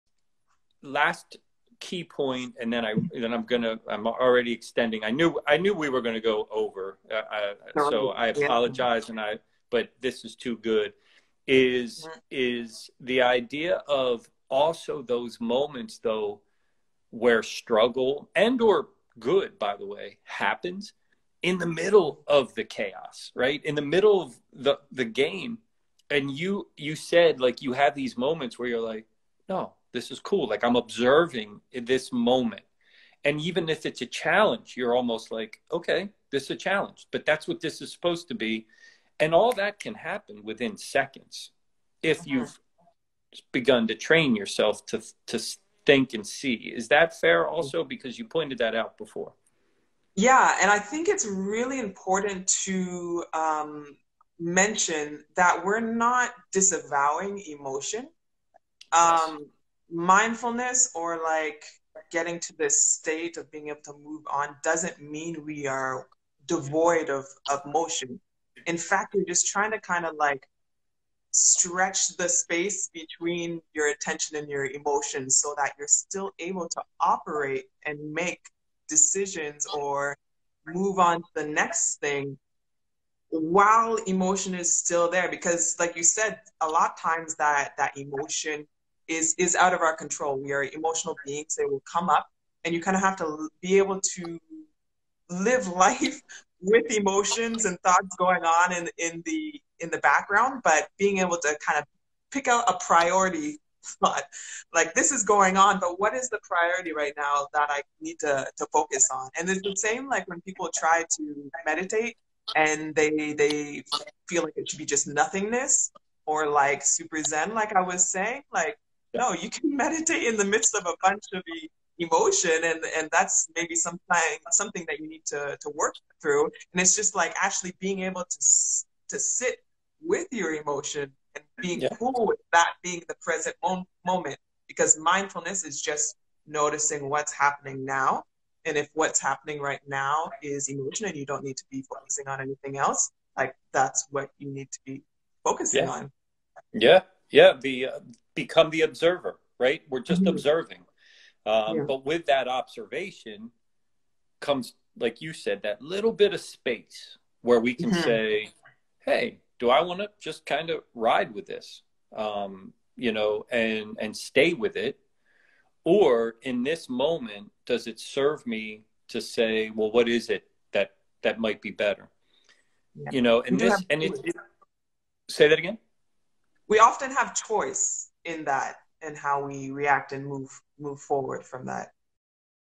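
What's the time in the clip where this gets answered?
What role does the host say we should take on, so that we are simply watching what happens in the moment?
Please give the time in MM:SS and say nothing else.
02:28.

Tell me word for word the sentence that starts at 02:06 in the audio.
And it's just like actually being able to to sit with your emotion and being yeah.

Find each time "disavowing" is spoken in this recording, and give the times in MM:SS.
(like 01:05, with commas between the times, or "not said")
00:56.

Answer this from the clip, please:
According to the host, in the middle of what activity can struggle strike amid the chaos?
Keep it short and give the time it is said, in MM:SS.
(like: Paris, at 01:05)
the game, at 00:24.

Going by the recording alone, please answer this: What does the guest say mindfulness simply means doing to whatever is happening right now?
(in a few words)
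noticing.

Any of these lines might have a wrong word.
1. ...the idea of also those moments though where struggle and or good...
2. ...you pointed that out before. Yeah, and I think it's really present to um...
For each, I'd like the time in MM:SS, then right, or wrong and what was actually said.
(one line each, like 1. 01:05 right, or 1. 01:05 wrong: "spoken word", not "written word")
1. 00:12 right
2. 00:48 wrong: "important", not "present".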